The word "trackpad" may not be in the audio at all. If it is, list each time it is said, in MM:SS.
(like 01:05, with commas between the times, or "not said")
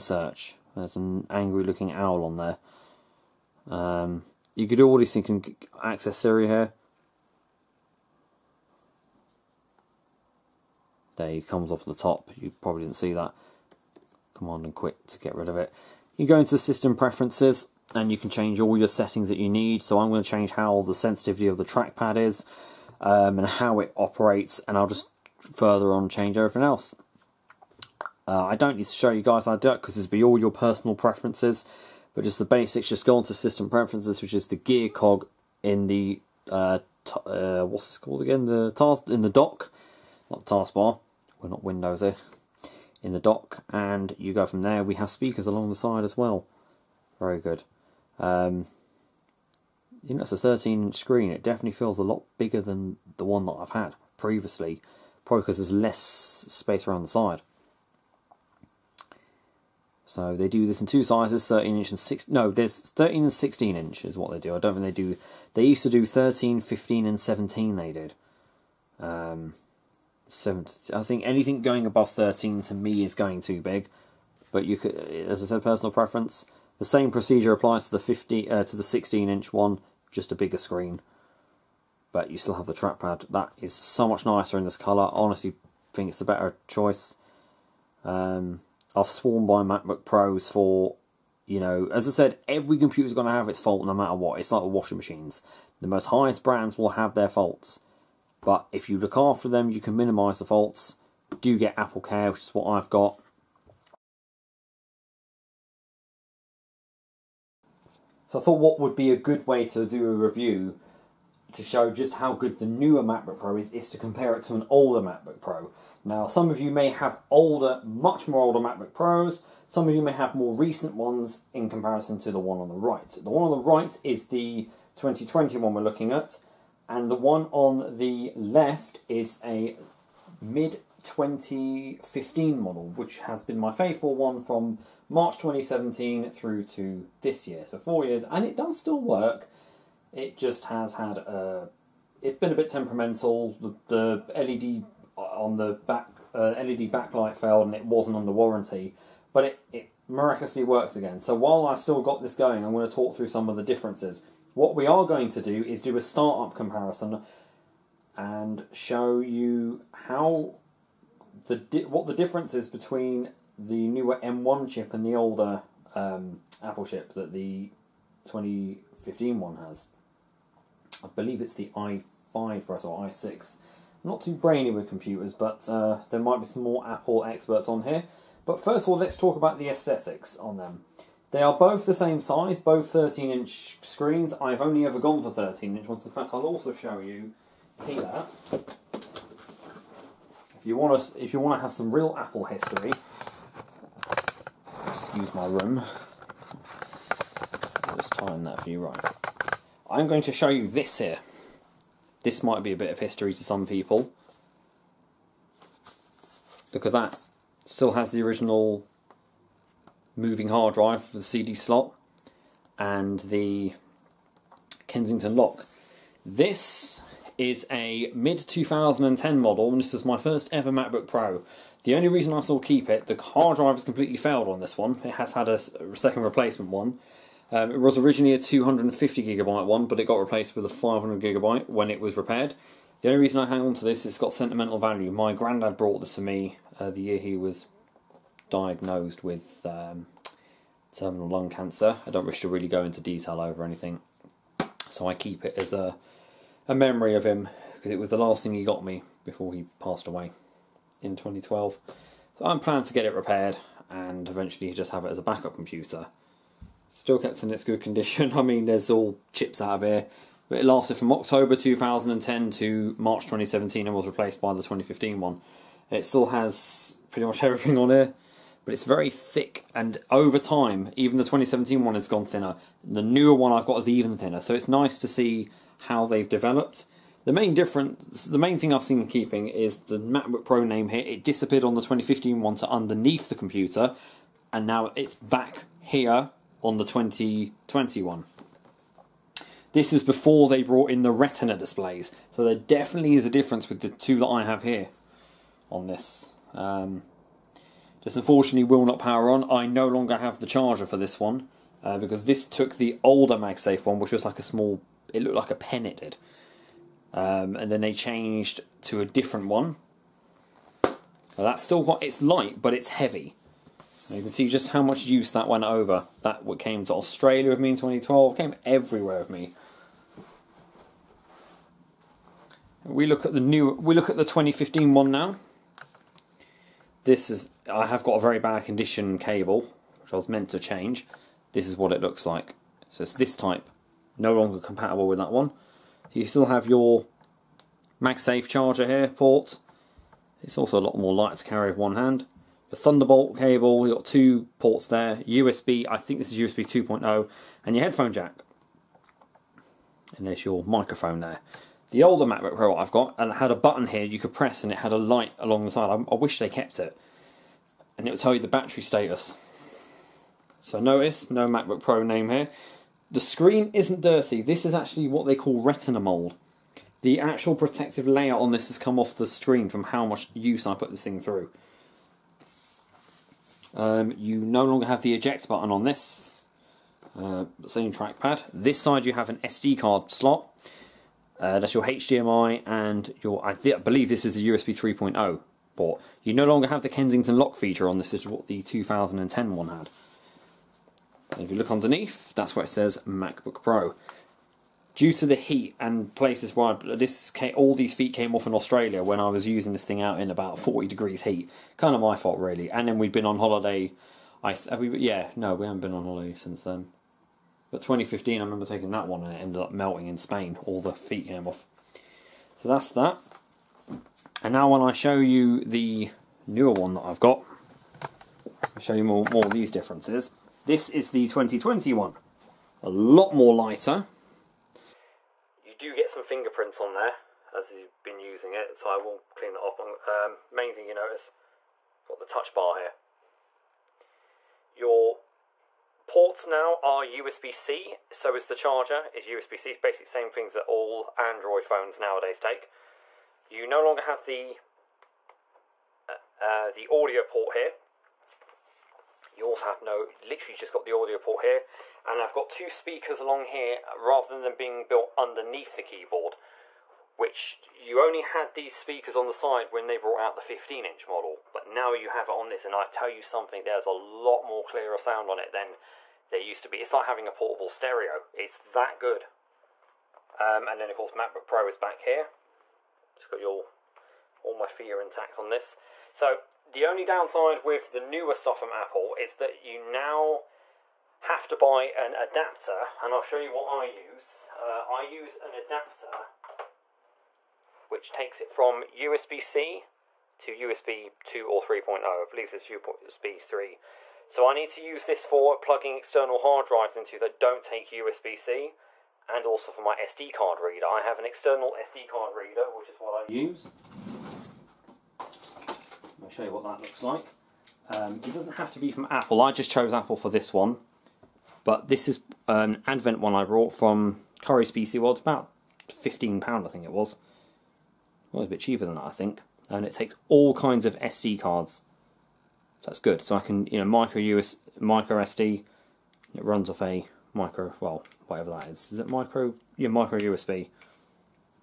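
00:21, 01:22, 06:17.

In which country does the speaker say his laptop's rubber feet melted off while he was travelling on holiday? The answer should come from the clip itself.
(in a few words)
Spain.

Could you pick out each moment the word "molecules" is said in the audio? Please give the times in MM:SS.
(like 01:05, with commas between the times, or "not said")
not said.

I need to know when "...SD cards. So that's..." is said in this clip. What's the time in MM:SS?
08:40.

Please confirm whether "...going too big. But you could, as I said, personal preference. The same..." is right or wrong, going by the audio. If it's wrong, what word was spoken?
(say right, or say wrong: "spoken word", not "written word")
right.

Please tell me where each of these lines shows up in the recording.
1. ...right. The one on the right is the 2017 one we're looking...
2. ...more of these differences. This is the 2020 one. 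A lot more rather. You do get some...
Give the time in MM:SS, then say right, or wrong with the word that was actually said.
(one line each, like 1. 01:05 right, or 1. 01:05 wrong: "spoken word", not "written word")
1. 02:02 wrong: "2020", not "2017"
2. 06:59 wrong: "lighter", not "rather".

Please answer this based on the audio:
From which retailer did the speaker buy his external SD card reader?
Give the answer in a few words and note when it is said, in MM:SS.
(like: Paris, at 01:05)
Currys PC World, at 08:34.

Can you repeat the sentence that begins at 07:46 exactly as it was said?
It's like having a portable stereo, it's that good.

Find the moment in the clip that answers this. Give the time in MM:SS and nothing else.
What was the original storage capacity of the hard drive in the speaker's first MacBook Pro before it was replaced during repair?
03:48.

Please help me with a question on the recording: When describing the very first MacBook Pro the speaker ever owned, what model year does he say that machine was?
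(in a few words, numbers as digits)
mid 2010.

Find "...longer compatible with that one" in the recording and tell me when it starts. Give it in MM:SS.
05:34.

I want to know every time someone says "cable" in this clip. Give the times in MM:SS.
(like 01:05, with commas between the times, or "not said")
05:29, 05:43.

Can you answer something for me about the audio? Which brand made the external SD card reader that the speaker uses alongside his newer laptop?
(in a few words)
Advent.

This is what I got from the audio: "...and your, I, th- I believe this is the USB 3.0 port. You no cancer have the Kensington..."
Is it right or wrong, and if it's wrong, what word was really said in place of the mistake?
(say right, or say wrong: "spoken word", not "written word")
wrong: "longer", not "cancer".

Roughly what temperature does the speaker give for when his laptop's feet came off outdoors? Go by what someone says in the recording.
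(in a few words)
40 degrees.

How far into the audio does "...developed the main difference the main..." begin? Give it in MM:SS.
04:36.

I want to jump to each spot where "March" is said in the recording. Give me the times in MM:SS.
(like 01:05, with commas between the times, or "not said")
02:15, 04:22.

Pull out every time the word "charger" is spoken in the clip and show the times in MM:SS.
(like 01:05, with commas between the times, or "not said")
05:00, 05:38, 07:18.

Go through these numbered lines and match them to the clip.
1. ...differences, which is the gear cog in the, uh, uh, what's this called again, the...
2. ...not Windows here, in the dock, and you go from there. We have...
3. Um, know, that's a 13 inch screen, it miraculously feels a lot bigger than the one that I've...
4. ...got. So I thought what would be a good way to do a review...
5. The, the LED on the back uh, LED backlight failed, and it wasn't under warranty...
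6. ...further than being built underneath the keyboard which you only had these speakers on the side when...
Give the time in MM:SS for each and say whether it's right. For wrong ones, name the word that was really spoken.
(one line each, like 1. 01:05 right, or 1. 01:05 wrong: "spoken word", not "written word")
1. 00:33 wrong: "preferences", not "differences"
2. 00:41 right
3. 00:48 wrong: "definitely", not "miraculously"
4. 01:42 right
5. 02:23 right
6. 07:33 wrong: "rather", not "further".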